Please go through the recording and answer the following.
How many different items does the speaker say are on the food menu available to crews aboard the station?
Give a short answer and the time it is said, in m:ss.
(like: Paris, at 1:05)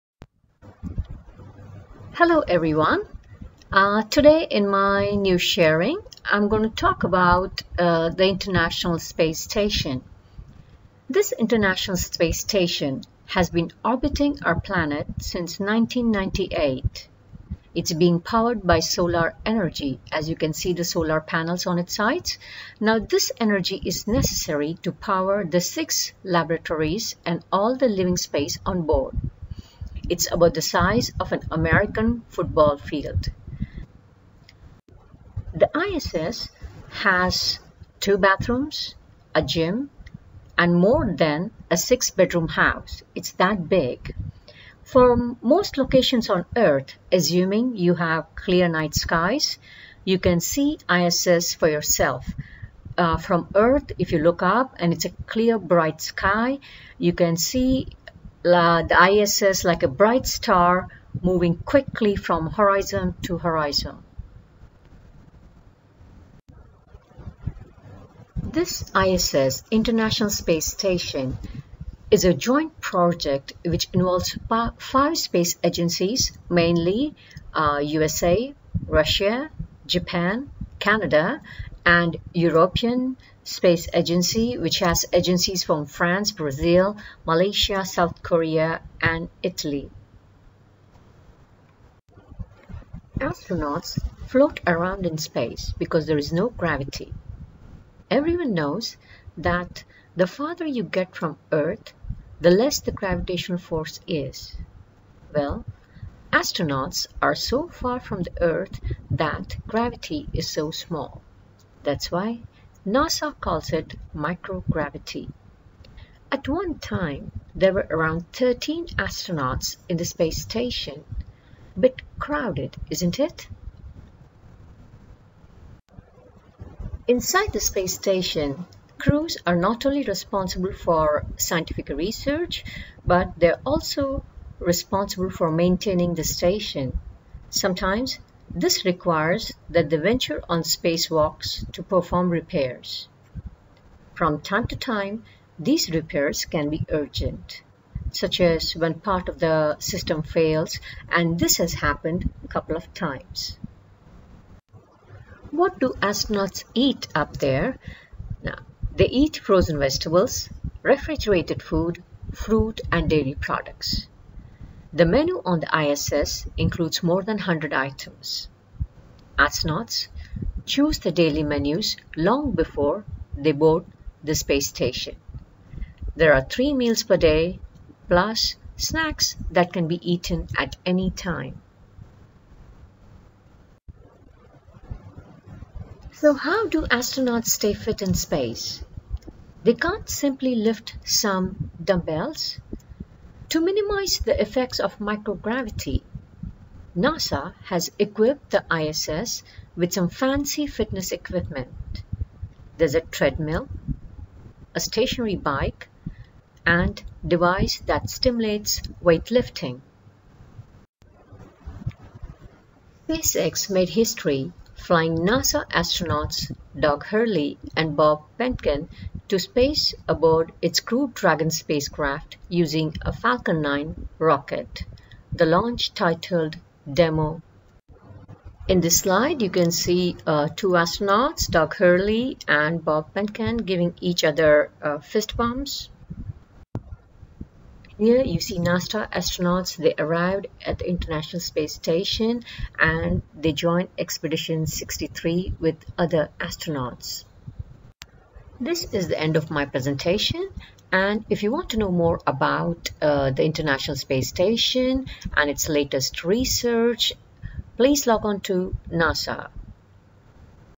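More than 100, at 2:47.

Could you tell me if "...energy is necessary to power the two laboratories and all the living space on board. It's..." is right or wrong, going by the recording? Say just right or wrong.
wrong.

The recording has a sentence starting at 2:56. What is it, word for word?
There are three meals per day, plus snacks that can be eaten at any time.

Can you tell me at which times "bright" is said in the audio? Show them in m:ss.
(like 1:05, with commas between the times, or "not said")
0:55, 0:59.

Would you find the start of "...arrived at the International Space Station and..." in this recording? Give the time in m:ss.
3:59.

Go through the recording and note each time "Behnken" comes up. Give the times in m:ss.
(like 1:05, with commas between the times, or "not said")
3:38, 3:53.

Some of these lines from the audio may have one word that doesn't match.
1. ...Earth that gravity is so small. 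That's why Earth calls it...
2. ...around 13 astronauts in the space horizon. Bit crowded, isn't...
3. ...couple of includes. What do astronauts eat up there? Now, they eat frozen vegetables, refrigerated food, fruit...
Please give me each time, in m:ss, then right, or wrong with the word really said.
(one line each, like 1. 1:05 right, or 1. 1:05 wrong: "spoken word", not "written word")
1. 1:48 wrong: "NASA", not "Earth"
2. 1:57 wrong: "station", not "horizon"
3. 2:32 wrong: "times", not "includes".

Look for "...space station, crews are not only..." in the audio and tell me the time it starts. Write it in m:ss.
2:07.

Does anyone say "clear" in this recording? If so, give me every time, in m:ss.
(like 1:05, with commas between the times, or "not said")
0:48, 0:55.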